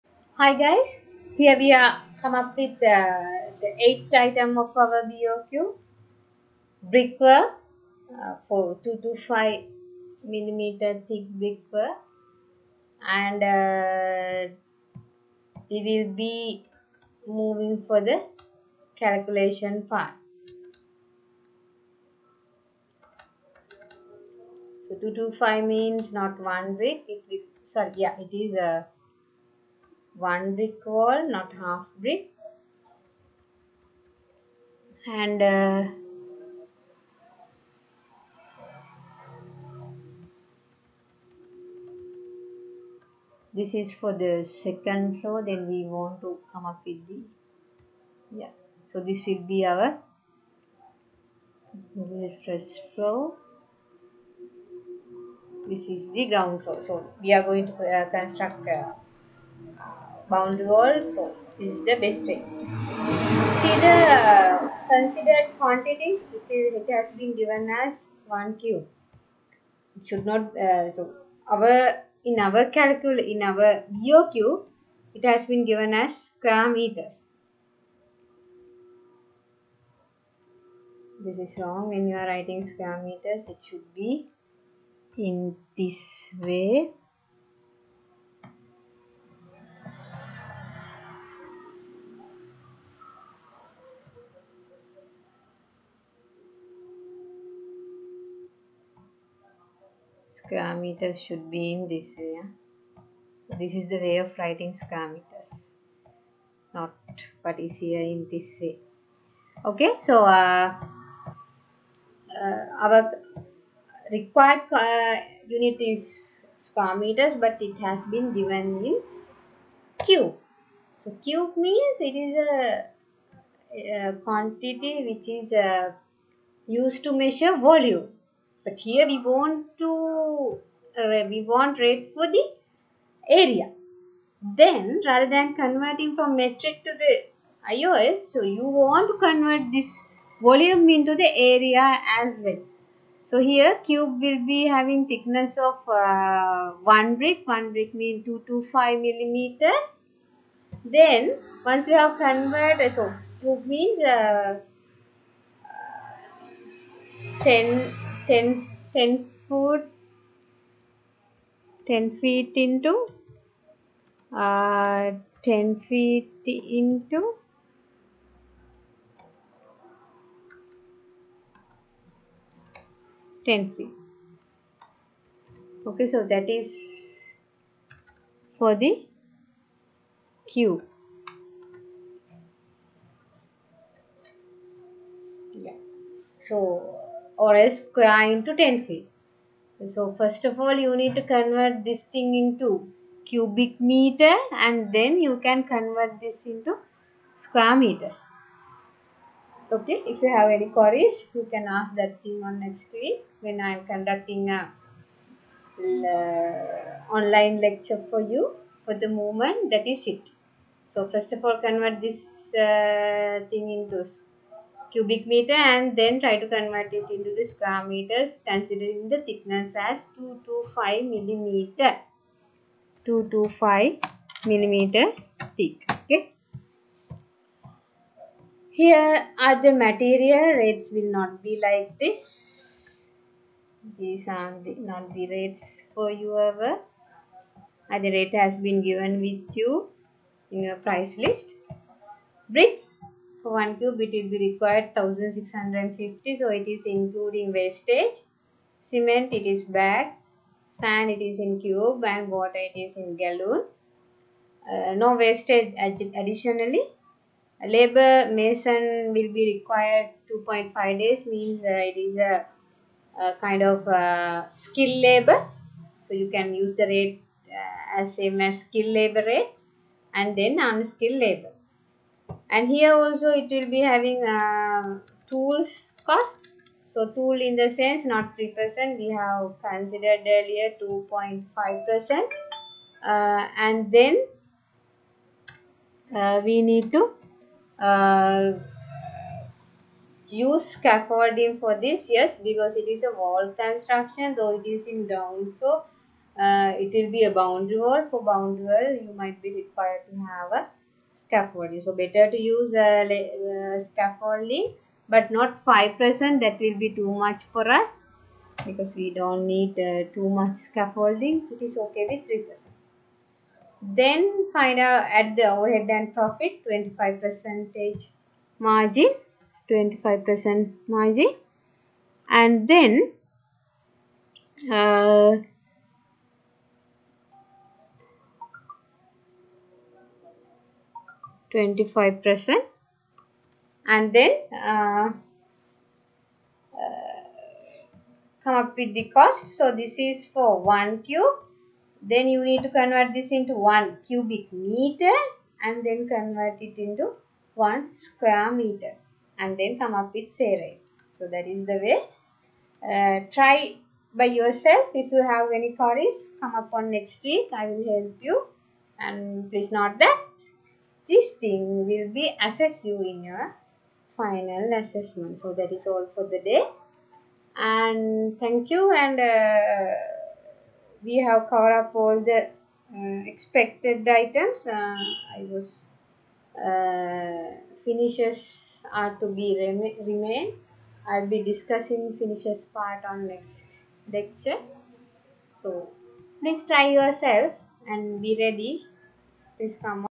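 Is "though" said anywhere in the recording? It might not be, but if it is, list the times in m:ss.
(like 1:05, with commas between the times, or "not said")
4:54.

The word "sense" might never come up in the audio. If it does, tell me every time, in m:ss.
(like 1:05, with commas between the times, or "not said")
4:37.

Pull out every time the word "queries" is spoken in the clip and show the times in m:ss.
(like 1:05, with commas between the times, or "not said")
3:20, 5:55.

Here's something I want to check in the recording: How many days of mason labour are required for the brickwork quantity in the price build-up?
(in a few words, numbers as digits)
2.5 days.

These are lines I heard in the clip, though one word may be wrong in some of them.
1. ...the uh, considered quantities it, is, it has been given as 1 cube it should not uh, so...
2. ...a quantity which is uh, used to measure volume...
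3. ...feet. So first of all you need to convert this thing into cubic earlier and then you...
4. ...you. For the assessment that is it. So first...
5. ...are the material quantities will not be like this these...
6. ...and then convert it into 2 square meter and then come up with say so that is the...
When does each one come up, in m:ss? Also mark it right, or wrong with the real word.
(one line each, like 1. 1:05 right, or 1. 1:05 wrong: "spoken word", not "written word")
1. 1:03 right
2. 2:03 right
3. 3:08 wrong: "meter", not "earlier"
4. 3:28 wrong: "moment", not "assessment"
5. 3:49 wrong: "rates", not "quantities"
6. 5:45 wrong: "1", not "2".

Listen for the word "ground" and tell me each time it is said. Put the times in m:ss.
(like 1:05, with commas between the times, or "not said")
0:56, 4:55.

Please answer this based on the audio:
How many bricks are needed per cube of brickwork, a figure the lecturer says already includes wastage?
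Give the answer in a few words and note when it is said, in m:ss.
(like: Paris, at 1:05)
1650, at 4:04.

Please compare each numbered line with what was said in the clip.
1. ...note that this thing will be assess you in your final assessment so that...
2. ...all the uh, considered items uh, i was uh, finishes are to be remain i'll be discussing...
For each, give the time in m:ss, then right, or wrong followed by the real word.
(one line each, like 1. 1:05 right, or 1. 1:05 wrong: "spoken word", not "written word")
1. 5:59 right
2. 6:12 wrong: "expected", not "considered".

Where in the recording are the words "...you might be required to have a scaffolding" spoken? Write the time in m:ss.
4:59.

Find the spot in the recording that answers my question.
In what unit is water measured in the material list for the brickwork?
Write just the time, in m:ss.
4:13.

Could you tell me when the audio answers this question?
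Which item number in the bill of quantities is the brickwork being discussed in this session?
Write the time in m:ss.
0:03.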